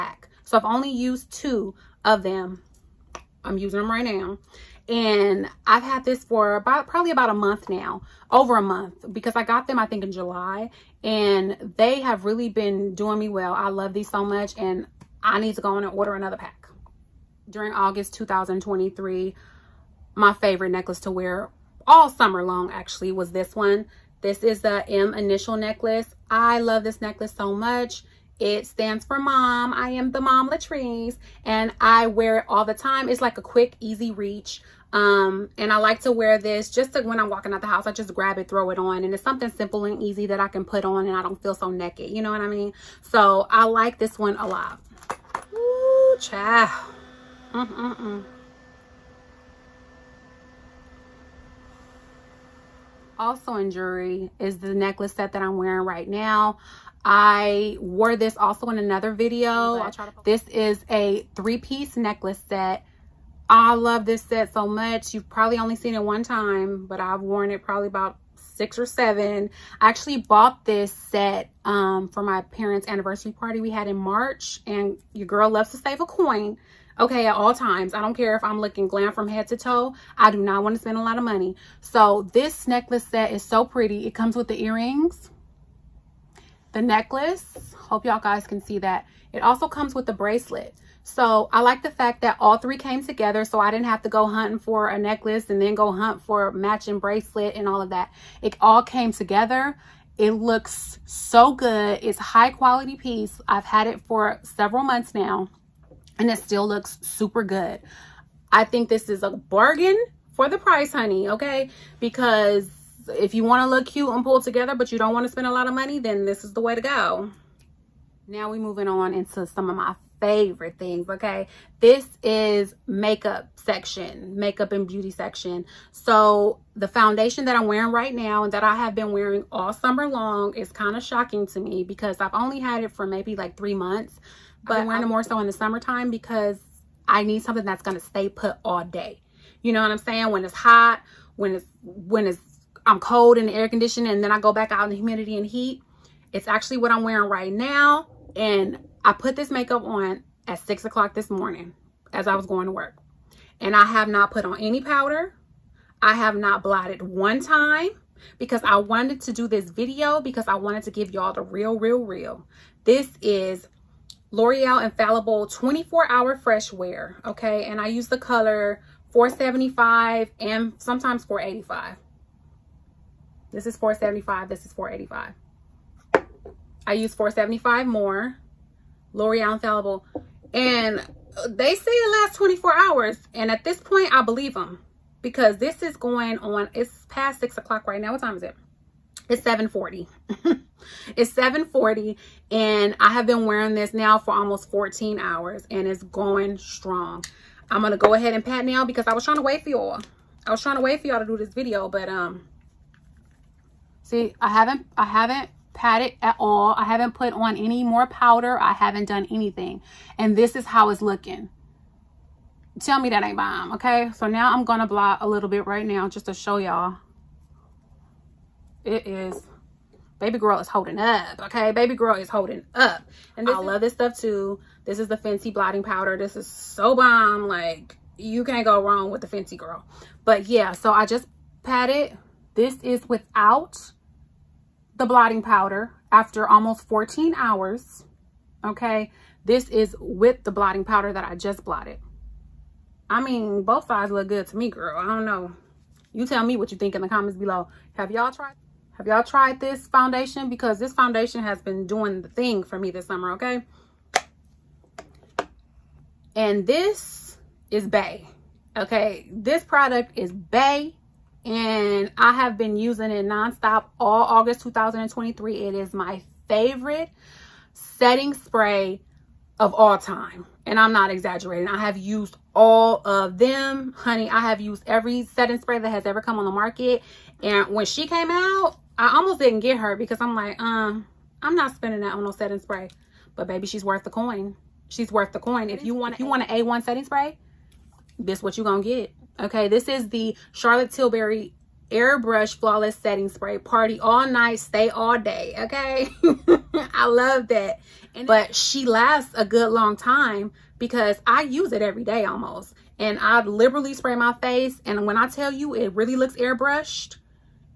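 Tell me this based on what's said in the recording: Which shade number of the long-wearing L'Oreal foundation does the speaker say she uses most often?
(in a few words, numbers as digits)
475.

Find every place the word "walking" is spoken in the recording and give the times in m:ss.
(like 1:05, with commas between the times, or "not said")
0:37.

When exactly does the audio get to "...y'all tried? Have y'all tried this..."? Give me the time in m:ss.
4:08.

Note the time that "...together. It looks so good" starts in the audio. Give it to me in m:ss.
1:39.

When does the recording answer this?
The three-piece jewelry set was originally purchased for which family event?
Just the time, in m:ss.
1:12.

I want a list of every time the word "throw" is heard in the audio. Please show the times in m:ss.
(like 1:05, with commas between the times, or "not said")
0:38.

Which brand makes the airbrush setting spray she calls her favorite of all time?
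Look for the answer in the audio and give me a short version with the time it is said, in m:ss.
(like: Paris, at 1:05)
Charlotte Tilbury, at 4:50.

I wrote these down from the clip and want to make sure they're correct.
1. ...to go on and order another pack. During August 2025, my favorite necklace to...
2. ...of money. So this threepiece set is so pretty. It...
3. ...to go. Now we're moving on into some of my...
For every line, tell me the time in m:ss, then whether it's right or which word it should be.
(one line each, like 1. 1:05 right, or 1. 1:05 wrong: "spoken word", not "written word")
1. 0:15 wrong: "2023", not "2025"
2. 1:21 wrong: "necklace", not "threepiece"
3. 1:56 right.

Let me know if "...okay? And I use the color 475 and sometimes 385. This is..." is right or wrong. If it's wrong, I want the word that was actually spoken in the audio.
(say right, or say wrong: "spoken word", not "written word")
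wrong: "485", not "385".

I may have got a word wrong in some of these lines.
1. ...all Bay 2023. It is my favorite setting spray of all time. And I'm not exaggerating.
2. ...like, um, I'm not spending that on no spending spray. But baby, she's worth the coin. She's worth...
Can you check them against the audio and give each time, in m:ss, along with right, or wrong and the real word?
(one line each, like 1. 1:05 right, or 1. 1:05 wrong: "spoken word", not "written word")
1. 4:23 wrong: "August", not "Bay"
2. 4:40 wrong: "setting", not "spending".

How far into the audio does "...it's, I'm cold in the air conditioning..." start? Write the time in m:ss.
2:22.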